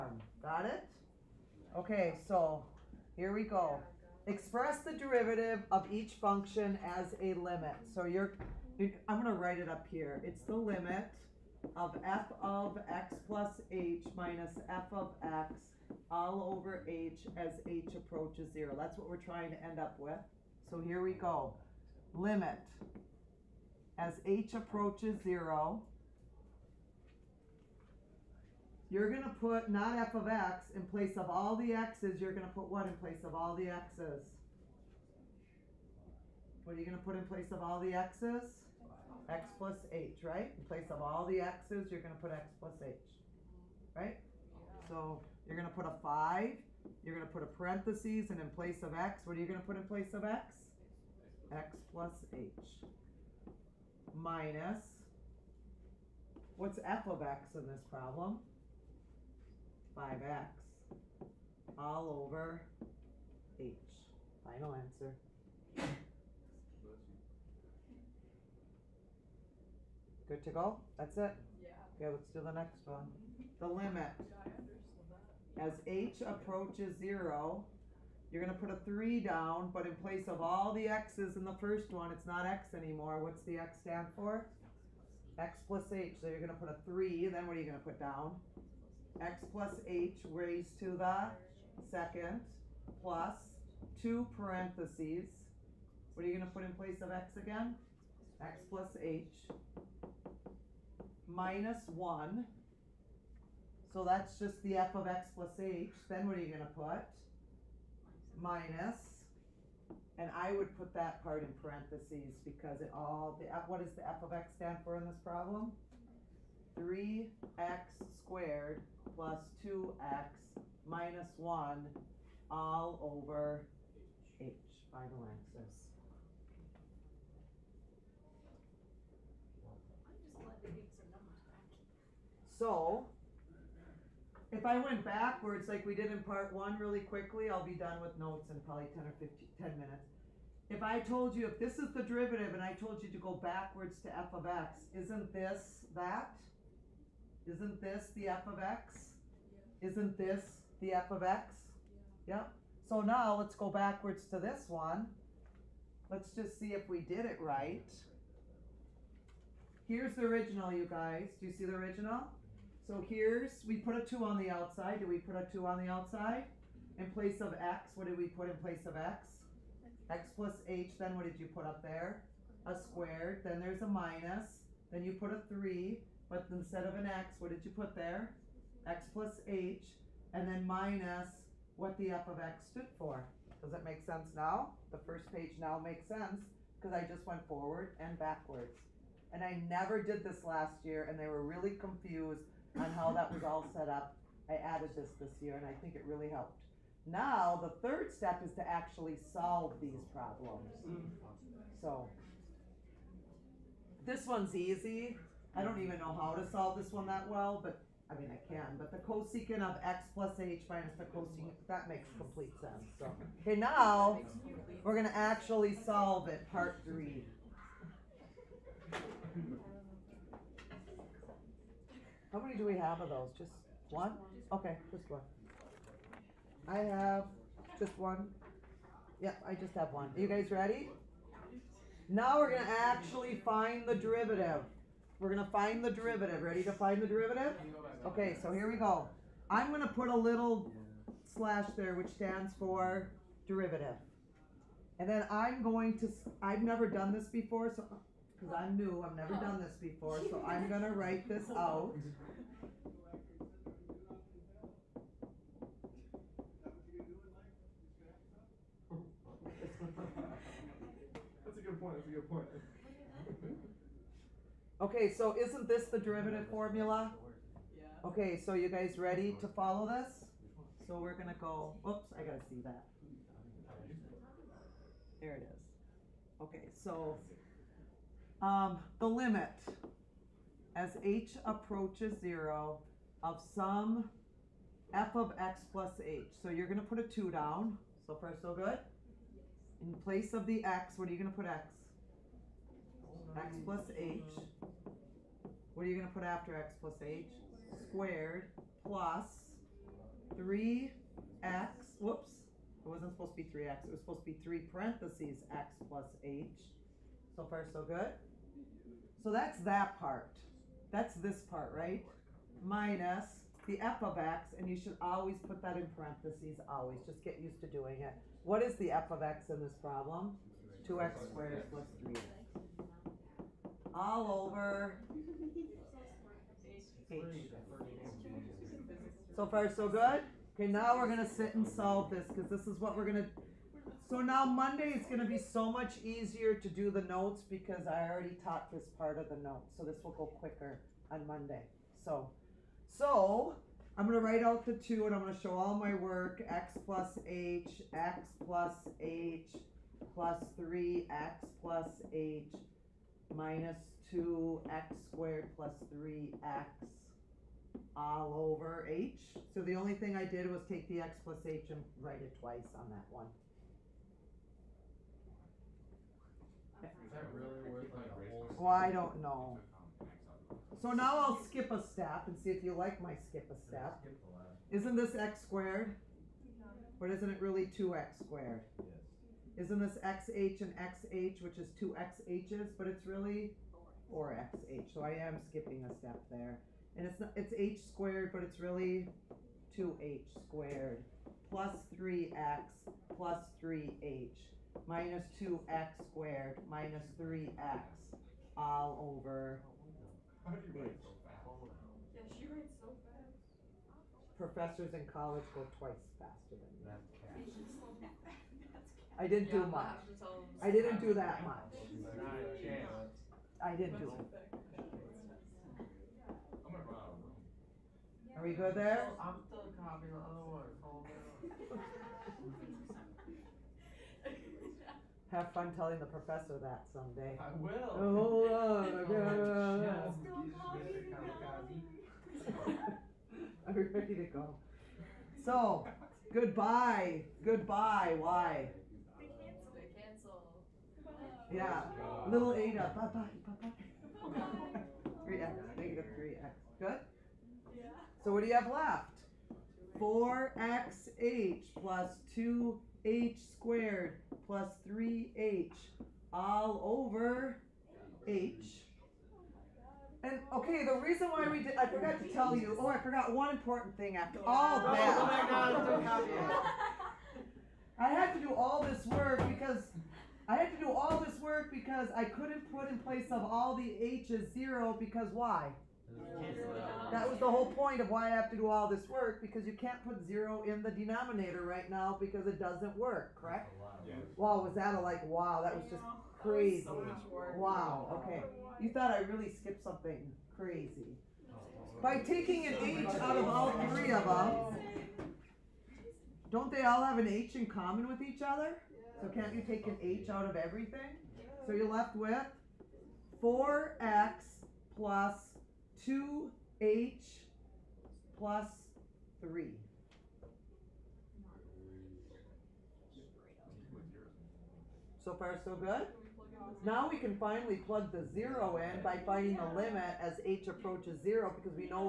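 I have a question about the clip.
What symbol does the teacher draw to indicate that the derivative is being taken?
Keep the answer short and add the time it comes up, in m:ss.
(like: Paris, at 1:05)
a little slash, at 4:00.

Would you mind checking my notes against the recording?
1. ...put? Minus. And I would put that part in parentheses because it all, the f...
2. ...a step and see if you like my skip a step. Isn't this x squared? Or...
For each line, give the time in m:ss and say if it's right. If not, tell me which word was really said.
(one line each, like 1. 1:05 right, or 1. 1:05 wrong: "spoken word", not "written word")
1. 1:46 right
2. 6:11 right.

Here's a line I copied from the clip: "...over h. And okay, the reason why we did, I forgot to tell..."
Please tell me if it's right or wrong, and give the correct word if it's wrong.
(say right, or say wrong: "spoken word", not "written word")
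right.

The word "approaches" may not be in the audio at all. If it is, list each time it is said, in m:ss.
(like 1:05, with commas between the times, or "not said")
0:17, 0:24, 1:16, 4:41, 8:40.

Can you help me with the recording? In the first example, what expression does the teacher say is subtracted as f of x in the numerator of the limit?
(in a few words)
5x.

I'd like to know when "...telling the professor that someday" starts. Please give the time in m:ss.
7:05.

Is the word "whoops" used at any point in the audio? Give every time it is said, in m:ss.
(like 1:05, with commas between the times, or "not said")
5:01.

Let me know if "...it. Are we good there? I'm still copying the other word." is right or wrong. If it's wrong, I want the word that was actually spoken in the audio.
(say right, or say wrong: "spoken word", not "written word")
right.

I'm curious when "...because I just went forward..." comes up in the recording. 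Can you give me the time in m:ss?
3:06.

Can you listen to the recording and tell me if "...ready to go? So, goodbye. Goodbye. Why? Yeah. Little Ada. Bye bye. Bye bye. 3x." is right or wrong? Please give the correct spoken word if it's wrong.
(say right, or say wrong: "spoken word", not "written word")
right.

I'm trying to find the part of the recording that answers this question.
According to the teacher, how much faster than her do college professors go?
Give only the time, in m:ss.
6:45.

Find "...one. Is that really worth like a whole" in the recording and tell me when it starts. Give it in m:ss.
6:03.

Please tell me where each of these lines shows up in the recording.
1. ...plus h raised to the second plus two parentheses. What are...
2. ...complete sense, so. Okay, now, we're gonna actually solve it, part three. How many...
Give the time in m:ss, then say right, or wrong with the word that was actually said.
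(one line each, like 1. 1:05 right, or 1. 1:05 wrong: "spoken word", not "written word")
1. 1:29 right
2. 3:32 right.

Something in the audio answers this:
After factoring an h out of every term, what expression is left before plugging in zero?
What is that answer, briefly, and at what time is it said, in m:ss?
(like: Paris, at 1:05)
4x plus 2h plus 3, at 8:23.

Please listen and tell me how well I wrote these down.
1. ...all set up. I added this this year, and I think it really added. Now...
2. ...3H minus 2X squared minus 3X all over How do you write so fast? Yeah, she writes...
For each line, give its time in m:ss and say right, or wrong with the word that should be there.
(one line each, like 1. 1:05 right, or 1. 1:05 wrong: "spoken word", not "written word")
1. 3:13 wrong: "helped", not "added"
2. 6:33 right.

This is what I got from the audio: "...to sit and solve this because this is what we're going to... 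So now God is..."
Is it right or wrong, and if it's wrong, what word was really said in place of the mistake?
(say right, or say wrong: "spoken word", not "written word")
wrong: "Monday", not "God".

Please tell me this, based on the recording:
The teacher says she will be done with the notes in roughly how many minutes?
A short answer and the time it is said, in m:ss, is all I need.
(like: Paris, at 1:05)
10 minutes, at 2:19.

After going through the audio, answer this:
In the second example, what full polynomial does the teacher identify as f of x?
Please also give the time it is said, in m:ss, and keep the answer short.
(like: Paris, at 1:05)
3x squared plus 2x minus 1, at 1:56.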